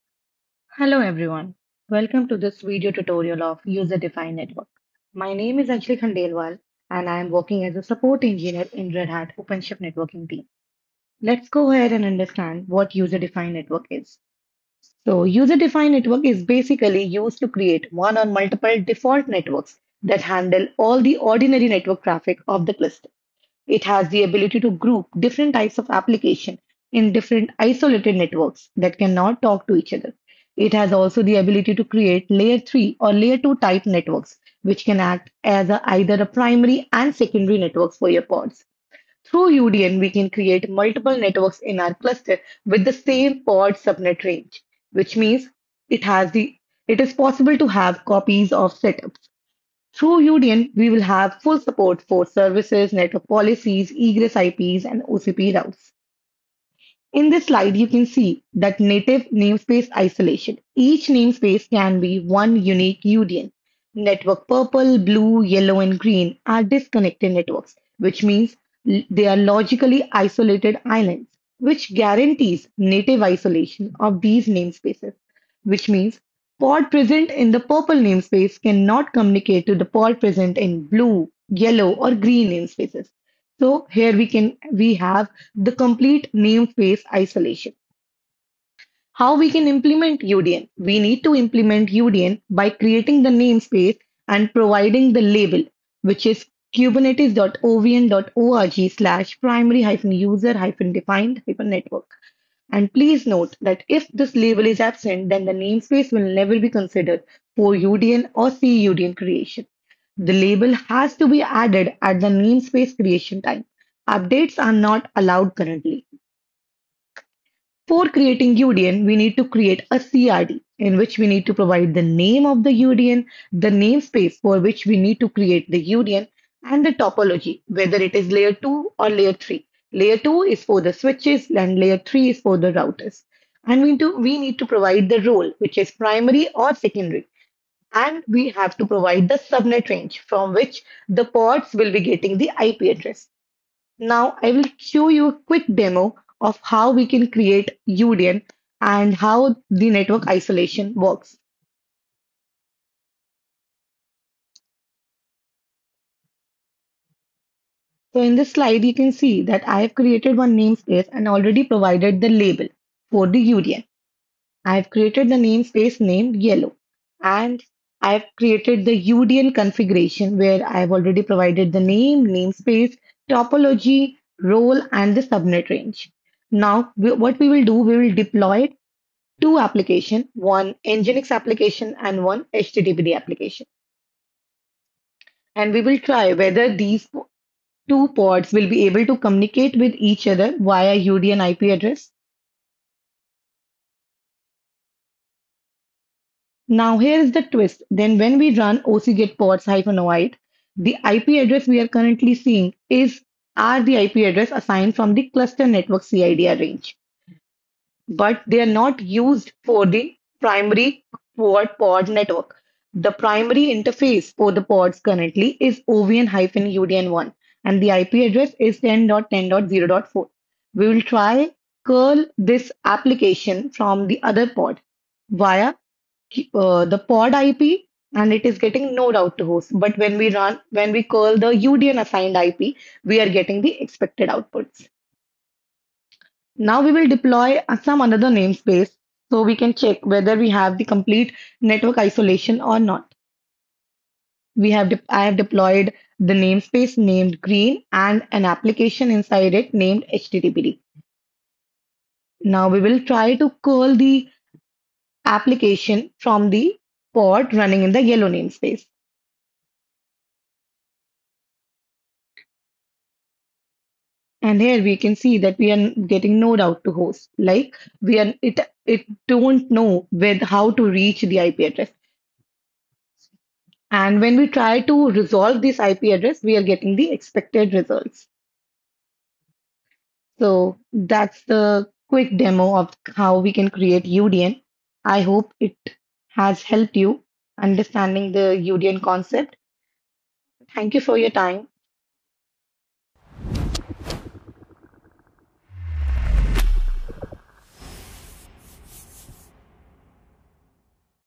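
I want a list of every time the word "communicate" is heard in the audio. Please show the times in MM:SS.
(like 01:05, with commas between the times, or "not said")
01:19, 03:09.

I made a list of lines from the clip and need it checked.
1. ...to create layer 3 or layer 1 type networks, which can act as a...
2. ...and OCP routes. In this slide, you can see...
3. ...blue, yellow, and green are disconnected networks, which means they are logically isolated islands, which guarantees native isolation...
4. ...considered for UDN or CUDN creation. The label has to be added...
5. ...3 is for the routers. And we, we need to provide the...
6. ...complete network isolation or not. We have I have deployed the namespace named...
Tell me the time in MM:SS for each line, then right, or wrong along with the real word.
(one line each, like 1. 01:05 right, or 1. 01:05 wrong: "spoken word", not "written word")
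1. 00:31 wrong: "2", not "1"
2. 00:54 right
3. 01:04 right
4. 01:46 right
5. 02:11 right
6. 04:00 right.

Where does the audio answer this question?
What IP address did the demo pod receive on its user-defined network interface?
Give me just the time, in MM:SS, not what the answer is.
03:38.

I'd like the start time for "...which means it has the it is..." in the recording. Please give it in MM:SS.
00:44.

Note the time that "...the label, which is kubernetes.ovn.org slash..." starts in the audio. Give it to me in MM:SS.
01:35.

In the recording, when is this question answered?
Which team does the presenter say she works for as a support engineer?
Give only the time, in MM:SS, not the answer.
00:08.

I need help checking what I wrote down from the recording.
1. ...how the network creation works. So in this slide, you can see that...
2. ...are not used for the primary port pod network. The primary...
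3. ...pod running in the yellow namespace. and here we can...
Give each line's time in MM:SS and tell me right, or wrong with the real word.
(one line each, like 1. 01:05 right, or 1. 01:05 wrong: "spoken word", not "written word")
1. 02:29 wrong: "isolation", not "creation"
2. 03:28 right
3. 04:17 right.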